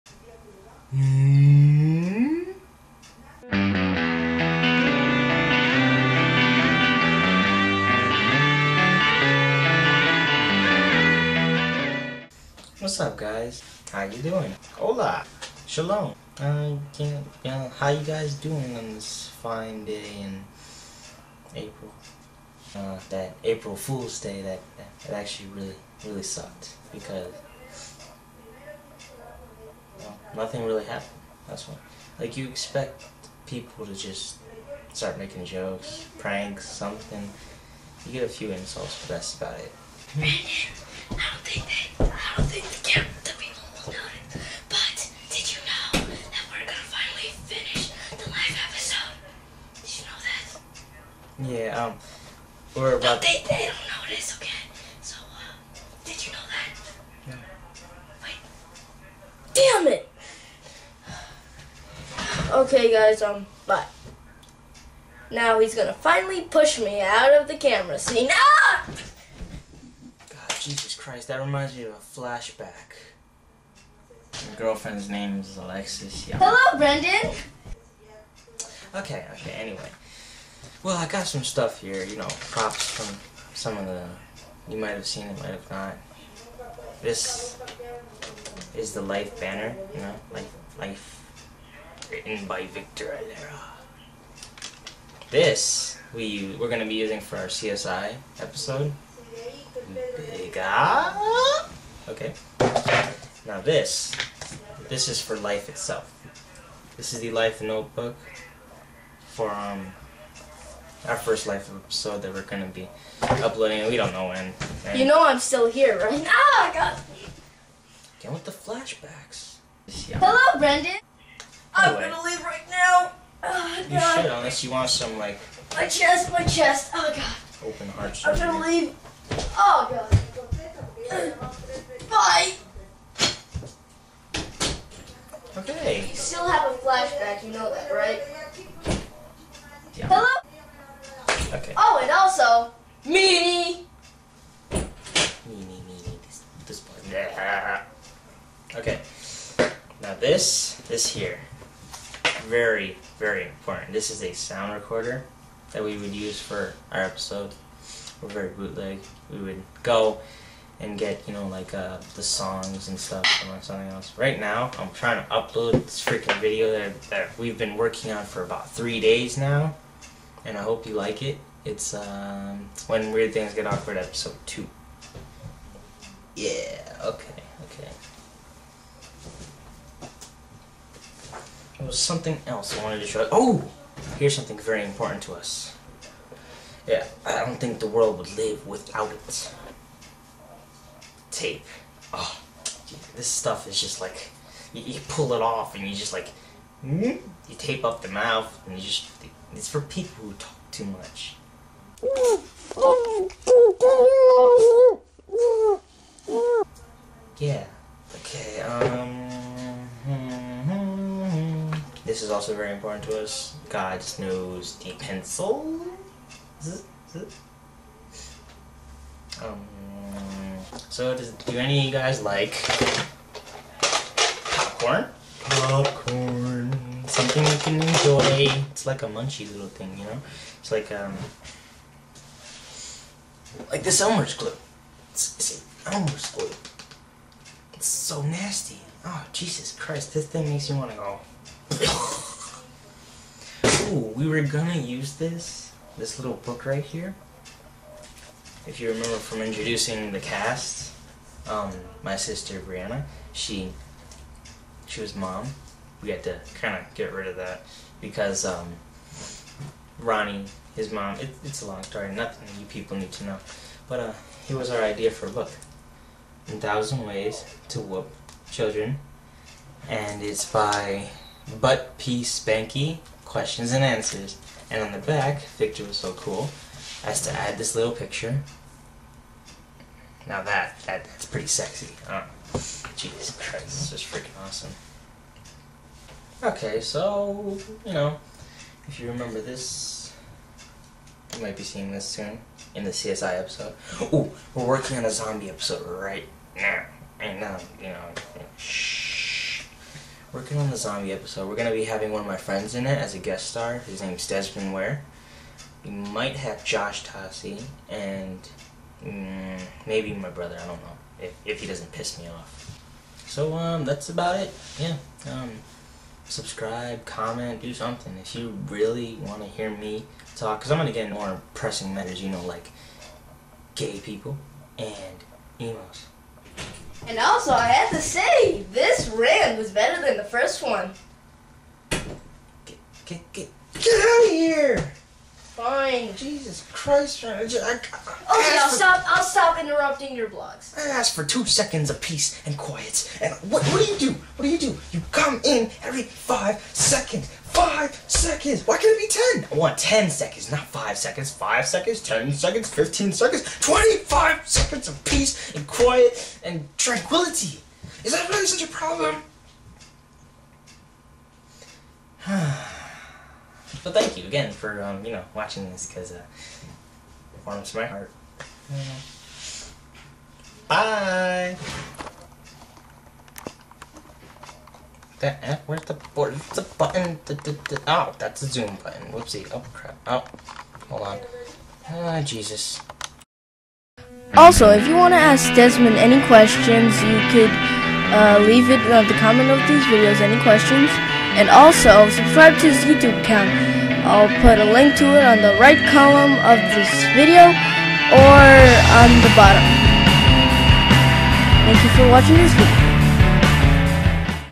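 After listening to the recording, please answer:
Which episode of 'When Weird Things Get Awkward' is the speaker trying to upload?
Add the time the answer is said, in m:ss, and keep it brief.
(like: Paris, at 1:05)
2, at 2:53.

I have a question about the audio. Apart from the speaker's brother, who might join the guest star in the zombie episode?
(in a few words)
Josh Tassi.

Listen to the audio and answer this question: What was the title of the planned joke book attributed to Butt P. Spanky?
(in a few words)
A Thousand Ways to Whoop Children.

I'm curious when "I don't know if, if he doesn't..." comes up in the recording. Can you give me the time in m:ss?
5:10.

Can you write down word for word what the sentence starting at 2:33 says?
This is a sound recorder that we would use for our episode.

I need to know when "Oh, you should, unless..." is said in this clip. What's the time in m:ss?
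2:03.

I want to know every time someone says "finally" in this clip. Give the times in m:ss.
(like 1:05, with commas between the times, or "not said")
0:46, 1:05.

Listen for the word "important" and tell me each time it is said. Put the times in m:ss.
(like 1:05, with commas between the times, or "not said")
2:33, 3:04, 3:32.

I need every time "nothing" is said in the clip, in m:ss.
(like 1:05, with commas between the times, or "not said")
0:30, 4:22.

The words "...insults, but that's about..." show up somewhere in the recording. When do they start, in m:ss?
0:38.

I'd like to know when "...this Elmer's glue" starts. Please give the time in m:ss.
3:53.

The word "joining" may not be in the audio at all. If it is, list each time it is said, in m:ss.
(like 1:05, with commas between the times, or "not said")
not said.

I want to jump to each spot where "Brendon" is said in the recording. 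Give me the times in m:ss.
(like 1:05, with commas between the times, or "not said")
1:16, 2:00.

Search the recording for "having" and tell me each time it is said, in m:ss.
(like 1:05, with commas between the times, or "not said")
5:01.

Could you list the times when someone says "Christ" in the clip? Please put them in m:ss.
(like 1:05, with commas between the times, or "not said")
1:10, 3:59, 4:43, 5:36.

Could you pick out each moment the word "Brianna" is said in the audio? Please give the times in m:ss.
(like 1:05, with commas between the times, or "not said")
4:12.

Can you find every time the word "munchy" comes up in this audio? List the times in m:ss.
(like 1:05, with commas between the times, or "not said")
3:49.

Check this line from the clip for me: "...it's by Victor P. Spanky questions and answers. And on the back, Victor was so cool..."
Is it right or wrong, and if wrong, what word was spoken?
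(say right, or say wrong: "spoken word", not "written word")
wrong: "Butt", not "Victor".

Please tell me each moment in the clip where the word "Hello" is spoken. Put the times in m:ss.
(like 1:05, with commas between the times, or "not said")
1:16, 2:00, 2:20.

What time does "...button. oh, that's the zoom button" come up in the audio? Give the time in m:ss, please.
6:16.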